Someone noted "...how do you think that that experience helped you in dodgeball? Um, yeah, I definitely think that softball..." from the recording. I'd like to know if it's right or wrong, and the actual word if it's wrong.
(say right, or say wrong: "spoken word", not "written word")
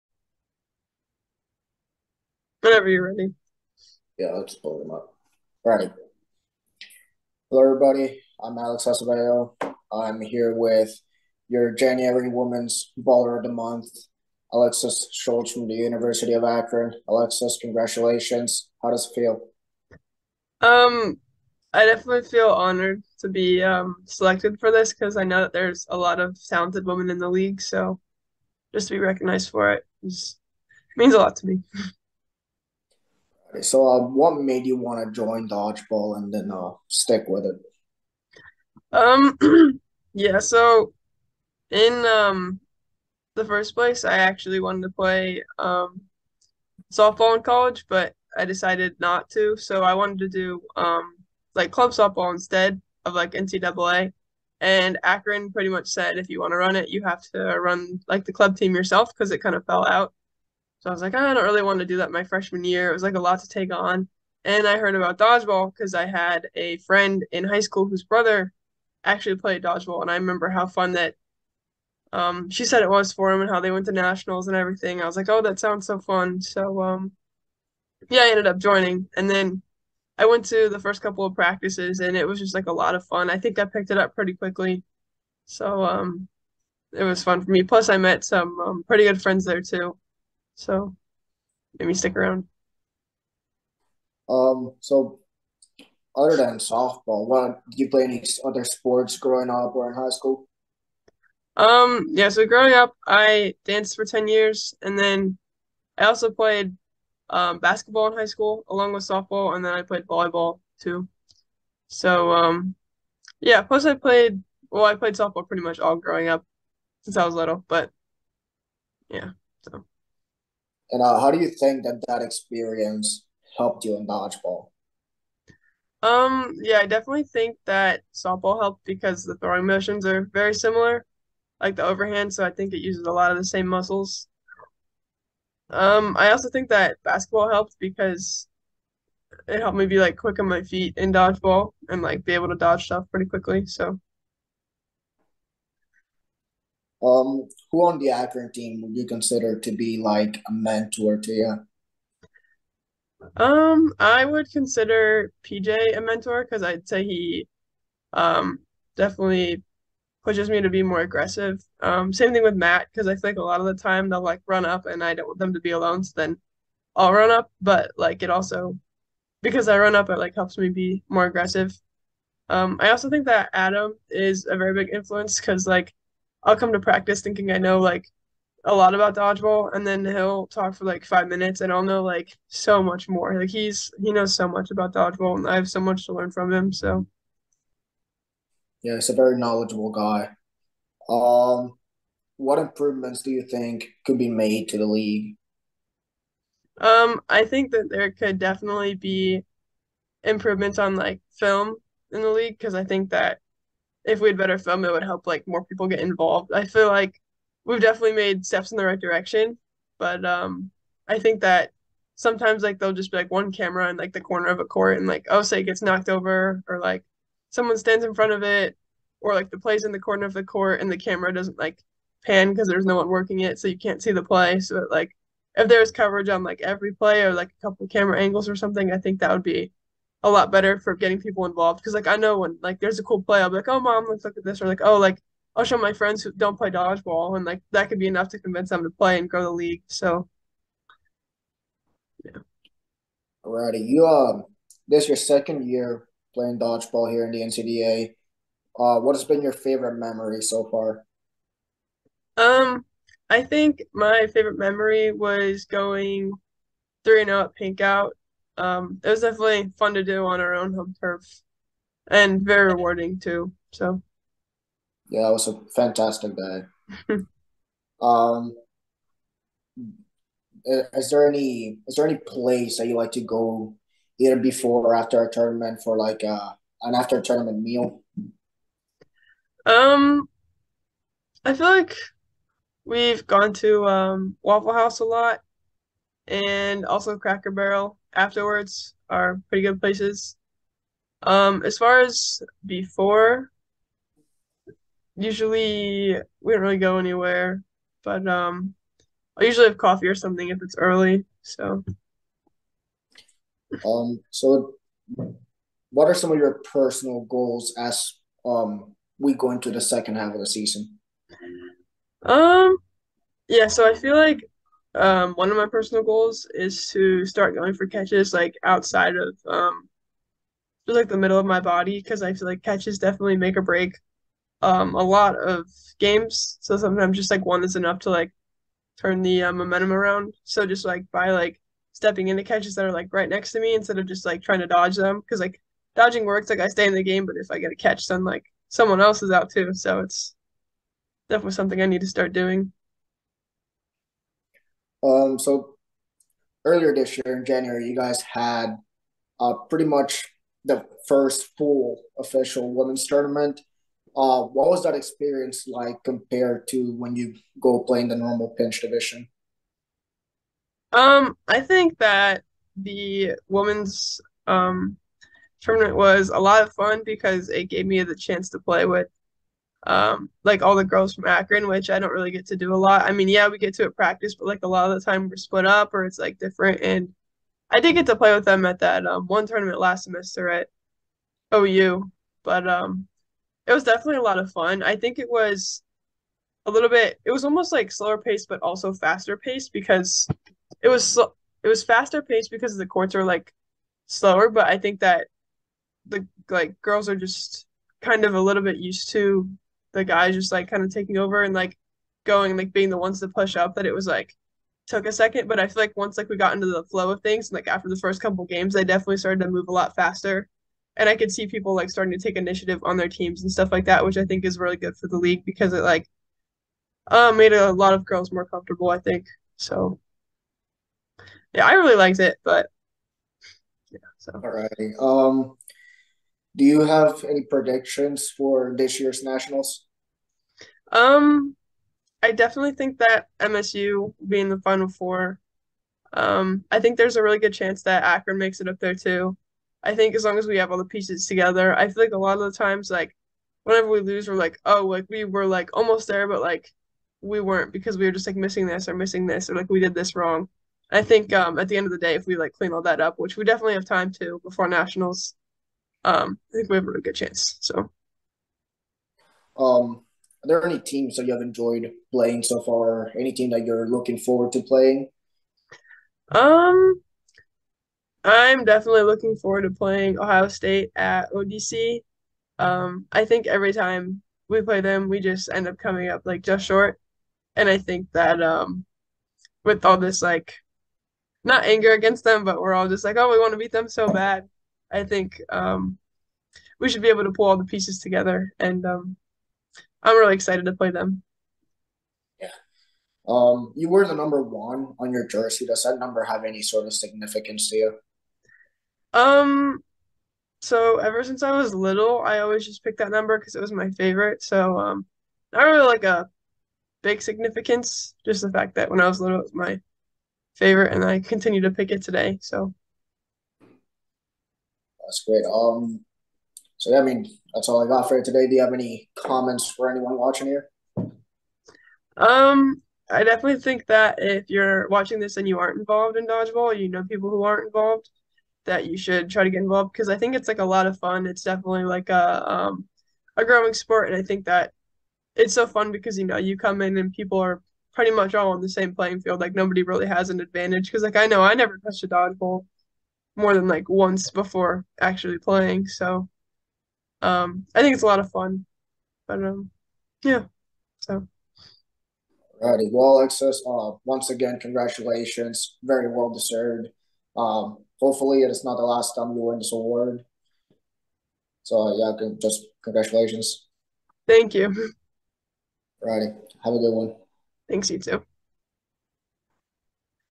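right.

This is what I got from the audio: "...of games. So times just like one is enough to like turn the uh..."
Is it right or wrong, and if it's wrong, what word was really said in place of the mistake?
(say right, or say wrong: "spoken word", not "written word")
wrong: "sometimes", not "times".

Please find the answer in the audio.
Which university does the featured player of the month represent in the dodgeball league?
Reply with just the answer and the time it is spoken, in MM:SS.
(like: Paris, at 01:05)
University of Akron, at 00:15.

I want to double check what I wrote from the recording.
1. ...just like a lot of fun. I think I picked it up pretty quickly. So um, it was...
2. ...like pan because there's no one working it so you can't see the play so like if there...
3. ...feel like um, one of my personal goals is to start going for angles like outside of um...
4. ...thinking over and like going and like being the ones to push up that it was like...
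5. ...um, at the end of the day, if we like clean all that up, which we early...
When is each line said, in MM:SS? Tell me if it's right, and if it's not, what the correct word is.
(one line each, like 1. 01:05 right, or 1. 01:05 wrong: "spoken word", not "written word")
1. 01:22 right
2. 03:41 right
3. 05:13 wrong: "catches", not "angles"
4. 06:40 wrong: "taking", not "thinking"
5. 07:31 wrong: "definitely", not "early".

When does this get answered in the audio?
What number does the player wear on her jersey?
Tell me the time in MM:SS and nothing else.
08:14.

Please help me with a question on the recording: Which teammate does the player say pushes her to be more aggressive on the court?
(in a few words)
PJ.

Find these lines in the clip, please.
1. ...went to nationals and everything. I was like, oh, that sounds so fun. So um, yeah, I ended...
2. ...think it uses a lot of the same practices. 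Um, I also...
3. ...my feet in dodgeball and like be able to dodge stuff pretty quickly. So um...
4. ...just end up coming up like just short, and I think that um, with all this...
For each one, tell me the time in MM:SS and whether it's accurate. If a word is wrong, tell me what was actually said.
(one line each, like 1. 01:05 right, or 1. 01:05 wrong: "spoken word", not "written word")
1. 01:13 right
2. 02:12 wrong: "muscles", not "practices"
3. 02:20 right
4. 07:55 right.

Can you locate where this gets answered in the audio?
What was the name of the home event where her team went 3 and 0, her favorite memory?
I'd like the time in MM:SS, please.
04:17.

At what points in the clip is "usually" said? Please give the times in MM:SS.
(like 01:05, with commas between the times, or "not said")
04:55, 04:59.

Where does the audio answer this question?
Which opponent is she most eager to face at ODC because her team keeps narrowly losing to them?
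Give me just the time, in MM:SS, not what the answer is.
07:50.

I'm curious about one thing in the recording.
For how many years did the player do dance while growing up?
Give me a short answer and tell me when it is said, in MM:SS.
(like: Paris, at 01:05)
10, at 01:44.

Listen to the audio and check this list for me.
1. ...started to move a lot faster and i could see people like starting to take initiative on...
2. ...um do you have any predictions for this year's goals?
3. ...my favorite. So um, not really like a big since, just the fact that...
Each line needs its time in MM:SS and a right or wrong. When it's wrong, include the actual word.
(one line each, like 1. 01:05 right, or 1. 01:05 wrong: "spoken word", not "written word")
1. 06:49 right
2. 07:04 wrong: "nationals", not "goals"
3. 08:23 wrong: "significance", not "since".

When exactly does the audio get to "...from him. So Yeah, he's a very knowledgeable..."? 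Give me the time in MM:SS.
03:06.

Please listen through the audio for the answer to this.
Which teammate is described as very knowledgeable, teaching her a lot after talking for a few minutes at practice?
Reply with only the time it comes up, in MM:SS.
02:53.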